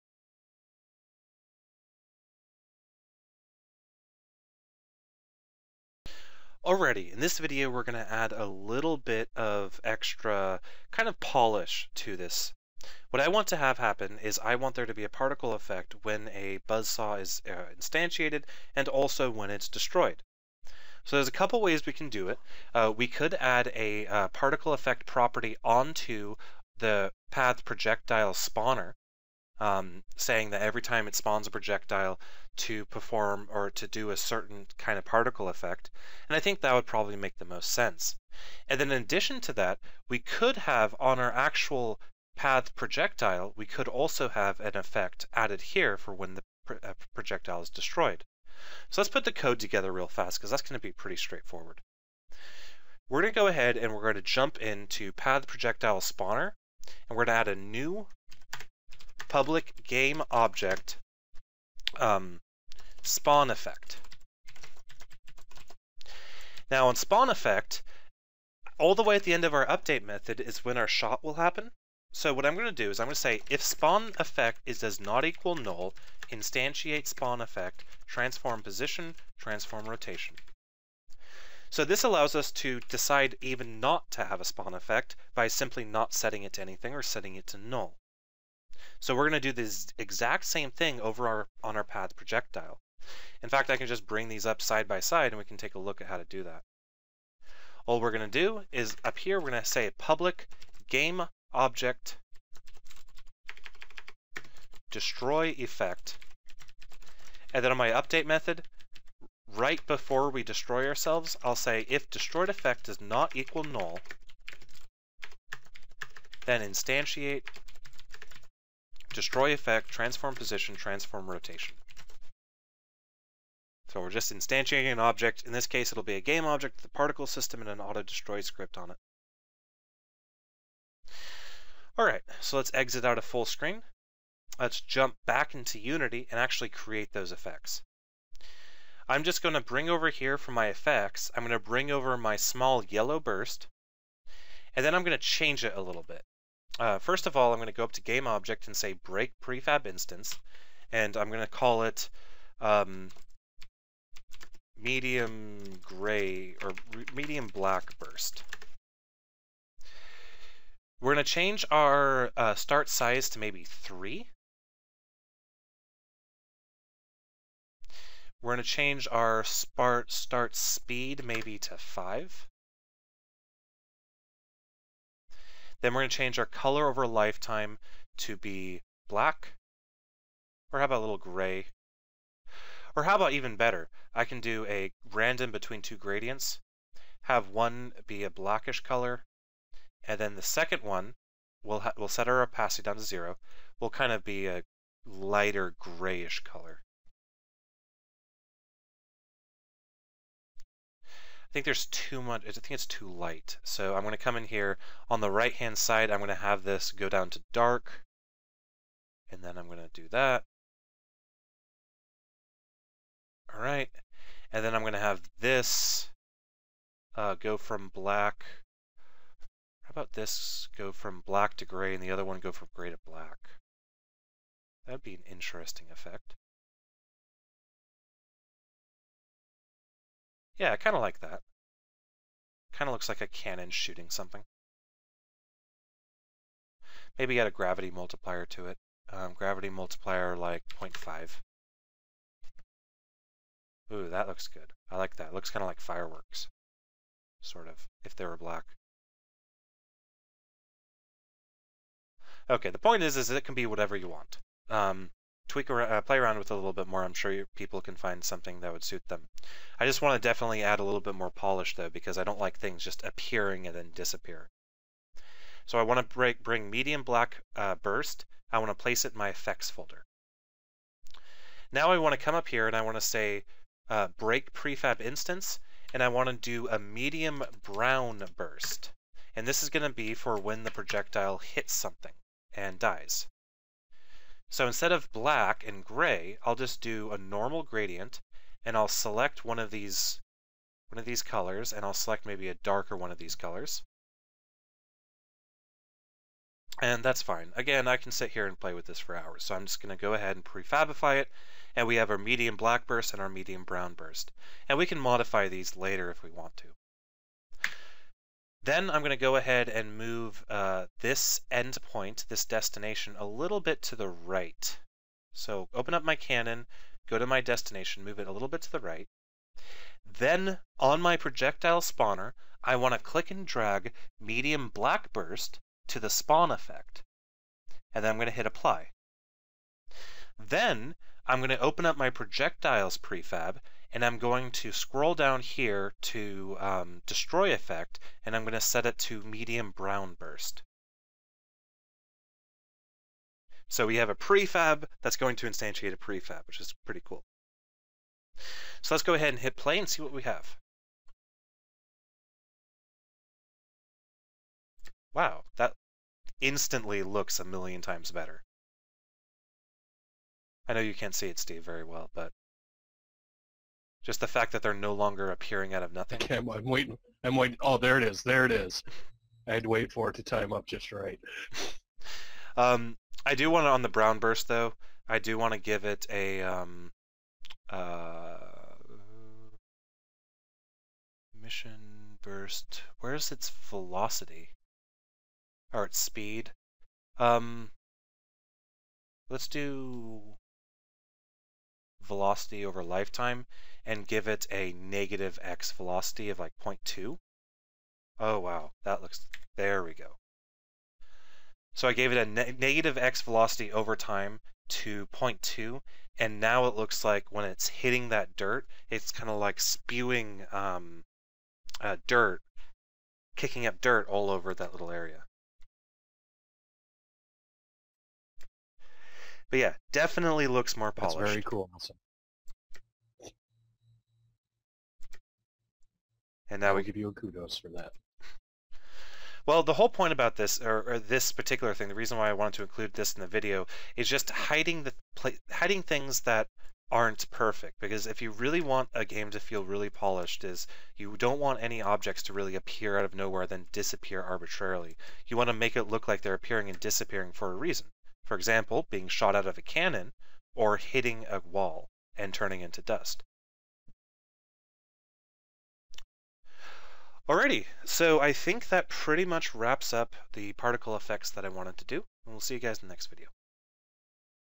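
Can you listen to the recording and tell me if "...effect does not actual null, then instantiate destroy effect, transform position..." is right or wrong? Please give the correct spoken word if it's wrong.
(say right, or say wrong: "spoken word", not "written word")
wrong: "equal", not "actual".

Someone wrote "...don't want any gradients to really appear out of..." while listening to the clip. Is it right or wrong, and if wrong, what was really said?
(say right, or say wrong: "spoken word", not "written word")
wrong: "objects", not "gradients".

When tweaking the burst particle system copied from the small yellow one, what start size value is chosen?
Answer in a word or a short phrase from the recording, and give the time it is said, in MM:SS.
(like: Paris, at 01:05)
3, at 02:43.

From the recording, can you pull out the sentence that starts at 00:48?
So let's put the code together real fast because that's going to be pretty straightforward.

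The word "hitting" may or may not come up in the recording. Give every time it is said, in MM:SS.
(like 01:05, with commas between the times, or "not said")
06:47, 07:30.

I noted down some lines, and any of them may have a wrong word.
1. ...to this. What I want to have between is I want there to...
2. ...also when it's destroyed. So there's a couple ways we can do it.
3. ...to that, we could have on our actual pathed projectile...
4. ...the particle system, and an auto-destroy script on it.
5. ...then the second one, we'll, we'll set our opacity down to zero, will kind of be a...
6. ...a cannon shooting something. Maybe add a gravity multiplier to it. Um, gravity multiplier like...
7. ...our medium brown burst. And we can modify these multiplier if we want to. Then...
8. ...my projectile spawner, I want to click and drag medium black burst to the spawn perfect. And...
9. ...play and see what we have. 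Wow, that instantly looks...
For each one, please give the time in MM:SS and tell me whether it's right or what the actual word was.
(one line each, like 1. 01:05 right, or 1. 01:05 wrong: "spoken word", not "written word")
1. 00:11 wrong: "happen", not "between"
2. 00:18 right
3. 00:39 right
4. 02:06 right
5. 03:10 right
6. 03:53 right
7. 05:03 wrong: "later", not "multiplier"
8. 05:21 wrong: "effect", not "perfect"
9. 05:49 right.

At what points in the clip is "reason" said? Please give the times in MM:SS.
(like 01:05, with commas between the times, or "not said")
07:11, 07:27.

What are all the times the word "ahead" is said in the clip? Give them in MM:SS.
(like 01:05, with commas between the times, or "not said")
00:53, 05:00, 05:09, 05:49.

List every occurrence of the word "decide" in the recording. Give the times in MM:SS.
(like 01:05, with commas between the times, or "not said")
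01:22.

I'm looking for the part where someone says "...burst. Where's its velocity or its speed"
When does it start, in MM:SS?
06:22.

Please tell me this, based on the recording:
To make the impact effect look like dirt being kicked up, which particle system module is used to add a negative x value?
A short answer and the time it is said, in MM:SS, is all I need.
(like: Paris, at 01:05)
velocity over lifetime, at 06:32.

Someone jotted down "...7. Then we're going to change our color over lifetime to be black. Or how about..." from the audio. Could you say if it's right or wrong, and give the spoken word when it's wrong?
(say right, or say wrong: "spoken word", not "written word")
wrong: "5", not "7".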